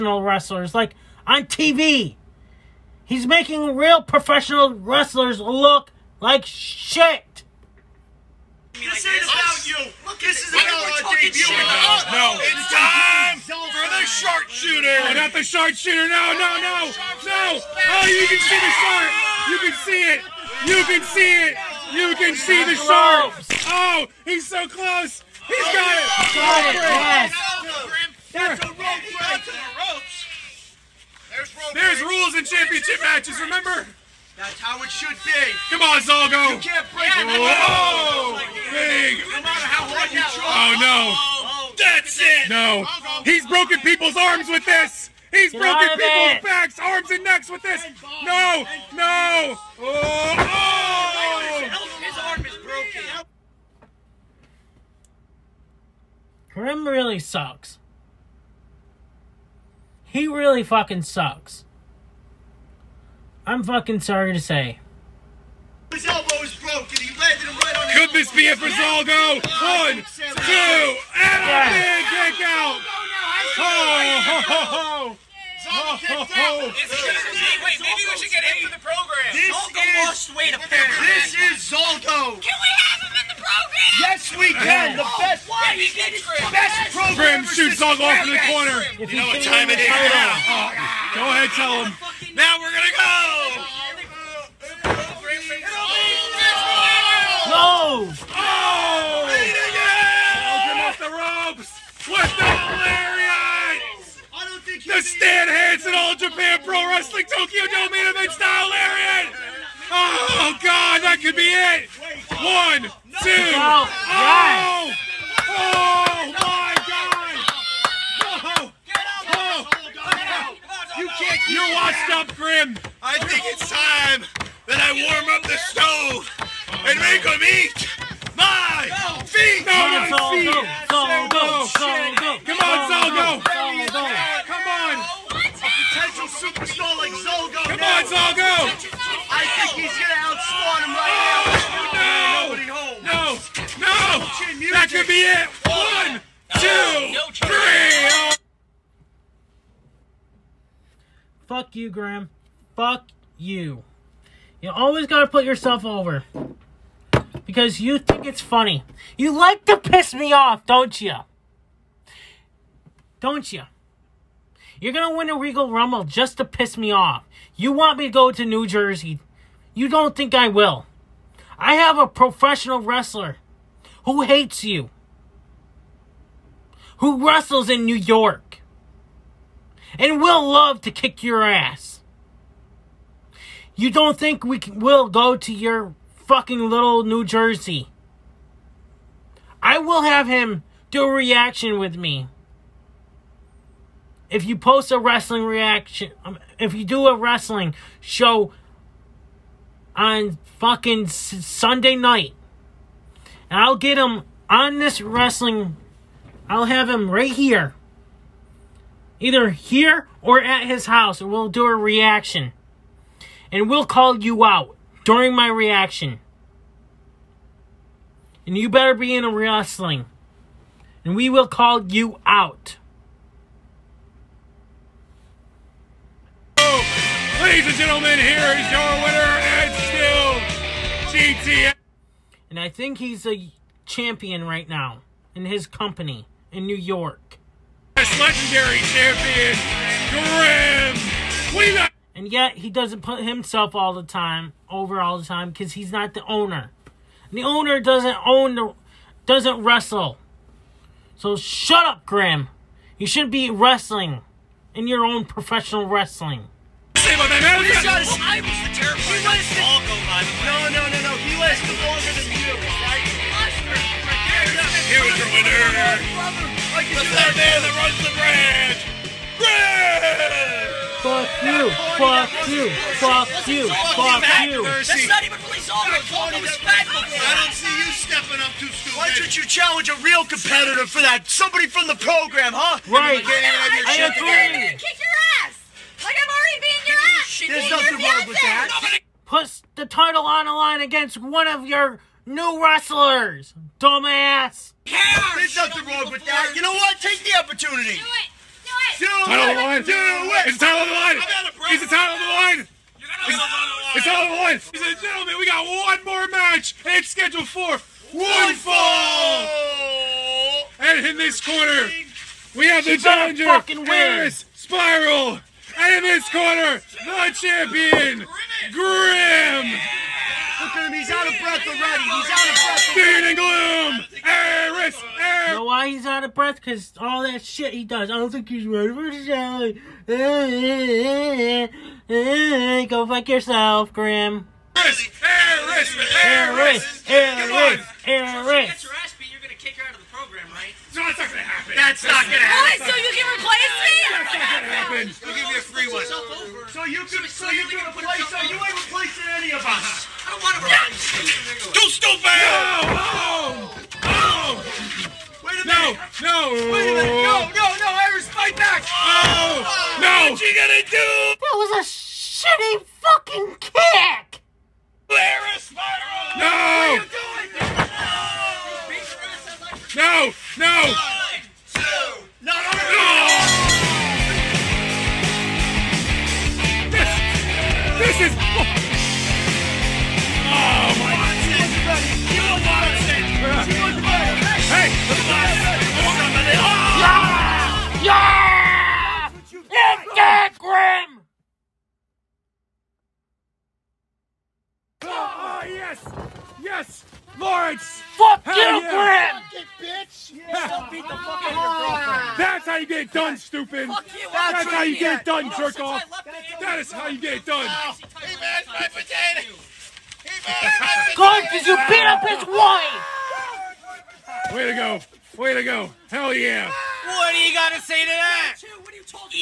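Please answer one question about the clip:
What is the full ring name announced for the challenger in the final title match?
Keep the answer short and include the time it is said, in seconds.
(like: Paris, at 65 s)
Harris Spiral, at 313 s.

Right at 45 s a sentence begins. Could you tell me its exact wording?
He's Get broken people's backs, arms, and necks with this.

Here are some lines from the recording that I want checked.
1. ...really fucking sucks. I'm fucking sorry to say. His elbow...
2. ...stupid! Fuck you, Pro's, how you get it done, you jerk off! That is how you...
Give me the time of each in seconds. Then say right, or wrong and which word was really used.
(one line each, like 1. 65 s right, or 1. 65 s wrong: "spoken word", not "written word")
1. 60 s right
2. 403 s wrong: "That", not "Pro".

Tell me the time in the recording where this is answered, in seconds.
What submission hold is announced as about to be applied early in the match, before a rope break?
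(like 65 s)
14 s.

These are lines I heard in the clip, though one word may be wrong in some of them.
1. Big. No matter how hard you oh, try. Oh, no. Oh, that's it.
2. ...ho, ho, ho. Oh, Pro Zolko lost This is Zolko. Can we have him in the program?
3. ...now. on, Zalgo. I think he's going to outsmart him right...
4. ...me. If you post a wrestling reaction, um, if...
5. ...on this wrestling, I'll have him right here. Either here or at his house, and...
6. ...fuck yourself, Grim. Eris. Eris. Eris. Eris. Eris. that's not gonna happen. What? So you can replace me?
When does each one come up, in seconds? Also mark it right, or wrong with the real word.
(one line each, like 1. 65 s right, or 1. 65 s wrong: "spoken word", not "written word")
1. 38 s right
2. 73 s wrong: "This", not "Pro"
3. 137 s right
4. 191 s right
5. 204 s right
6. 333 s right.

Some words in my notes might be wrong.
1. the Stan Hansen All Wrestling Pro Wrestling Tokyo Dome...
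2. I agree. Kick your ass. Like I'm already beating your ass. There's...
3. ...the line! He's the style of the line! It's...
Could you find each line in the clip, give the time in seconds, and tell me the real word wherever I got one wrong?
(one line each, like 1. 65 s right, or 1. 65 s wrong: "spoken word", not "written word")
1. 104 s wrong: "Japan", not "Wrestling"
2. 283 s right
3. 300 s wrong: "title", not "style".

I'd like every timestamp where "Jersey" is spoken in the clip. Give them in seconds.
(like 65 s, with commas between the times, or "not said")
168 s, 187 s.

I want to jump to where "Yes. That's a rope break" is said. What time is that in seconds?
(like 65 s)
27 s.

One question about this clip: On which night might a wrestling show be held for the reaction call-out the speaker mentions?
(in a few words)
Sunday.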